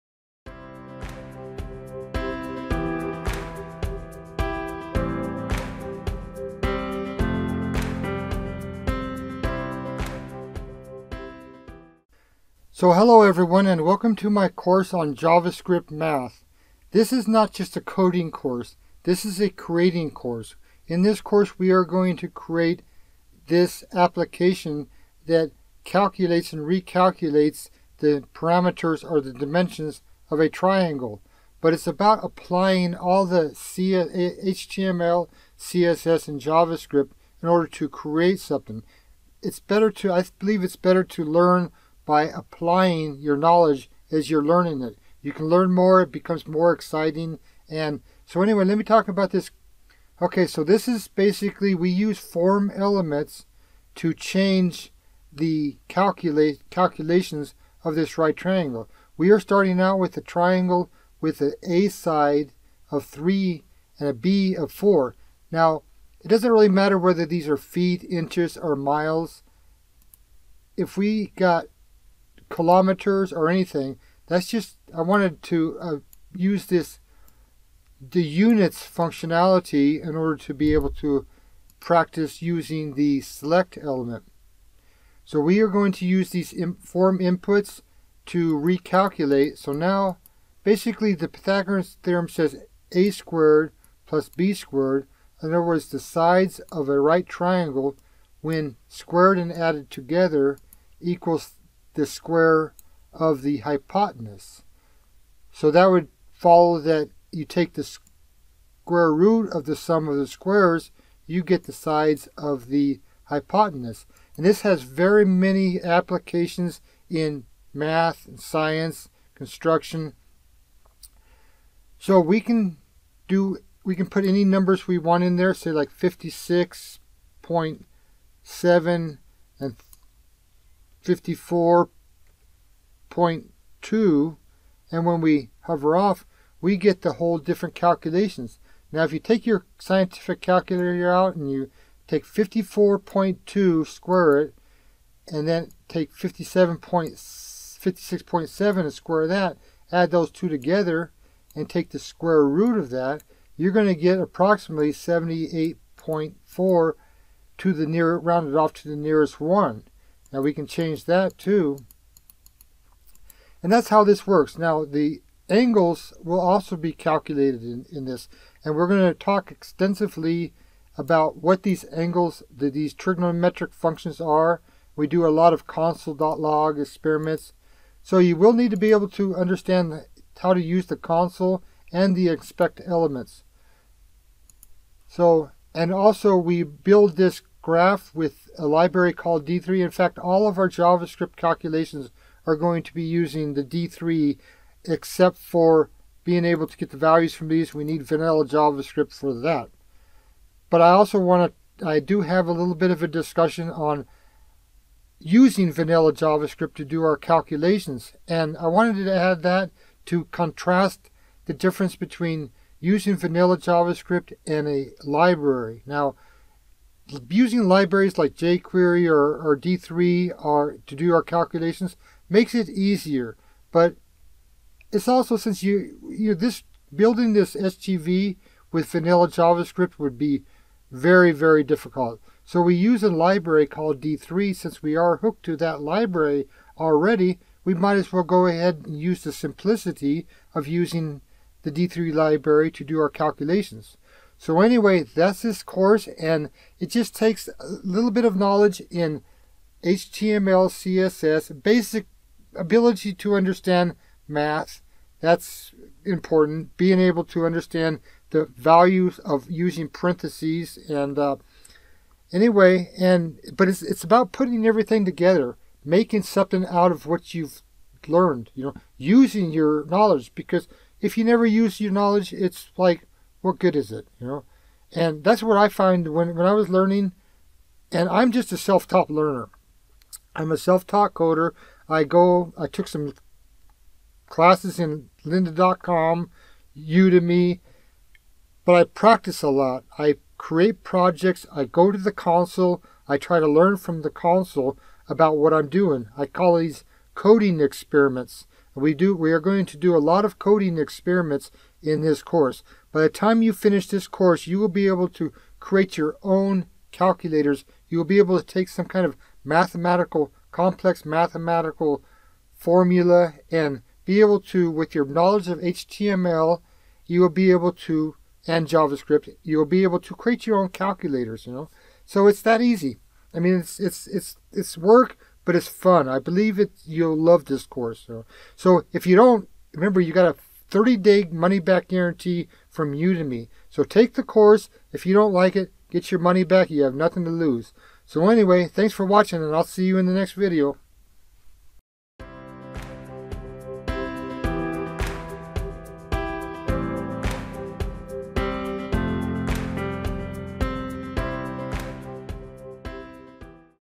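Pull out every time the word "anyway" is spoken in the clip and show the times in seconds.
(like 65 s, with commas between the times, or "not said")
48 s, 244 s, 262 s, 338 s.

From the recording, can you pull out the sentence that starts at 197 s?
We need vanilla JavaScript for that.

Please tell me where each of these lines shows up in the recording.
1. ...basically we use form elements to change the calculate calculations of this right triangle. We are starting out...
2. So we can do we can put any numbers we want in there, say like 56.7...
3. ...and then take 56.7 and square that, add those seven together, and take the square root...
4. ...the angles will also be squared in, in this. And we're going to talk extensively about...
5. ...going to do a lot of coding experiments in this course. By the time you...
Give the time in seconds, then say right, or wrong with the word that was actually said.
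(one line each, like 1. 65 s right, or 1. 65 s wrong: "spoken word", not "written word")
1. 51 s right
2. 121 s right
3. 145 s wrong: "two", not "seven"
4. 164 s wrong: "calculated", not "squared"
5. 299 s right.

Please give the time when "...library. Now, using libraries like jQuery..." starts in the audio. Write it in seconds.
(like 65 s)
215 s.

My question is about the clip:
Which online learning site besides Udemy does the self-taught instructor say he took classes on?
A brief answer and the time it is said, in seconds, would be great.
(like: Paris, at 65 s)
Lynda.com, at 285 s.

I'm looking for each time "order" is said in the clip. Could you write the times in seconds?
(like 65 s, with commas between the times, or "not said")
37 s, 80 s.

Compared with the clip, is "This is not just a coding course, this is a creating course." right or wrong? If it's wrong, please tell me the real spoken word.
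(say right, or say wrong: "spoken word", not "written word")
right.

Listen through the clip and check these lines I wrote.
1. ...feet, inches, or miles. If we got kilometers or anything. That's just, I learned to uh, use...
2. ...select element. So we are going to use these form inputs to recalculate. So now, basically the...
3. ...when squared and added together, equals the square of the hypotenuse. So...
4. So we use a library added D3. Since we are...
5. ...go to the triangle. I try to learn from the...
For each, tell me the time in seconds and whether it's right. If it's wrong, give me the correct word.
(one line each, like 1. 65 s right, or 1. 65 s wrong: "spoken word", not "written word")
1. 67 s wrong: "wanted", not "learned"
2. 83 s right
3. 98 s right
4. 232 s wrong: "called", not "added"
5. 291 s wrong: "console", not "triangle".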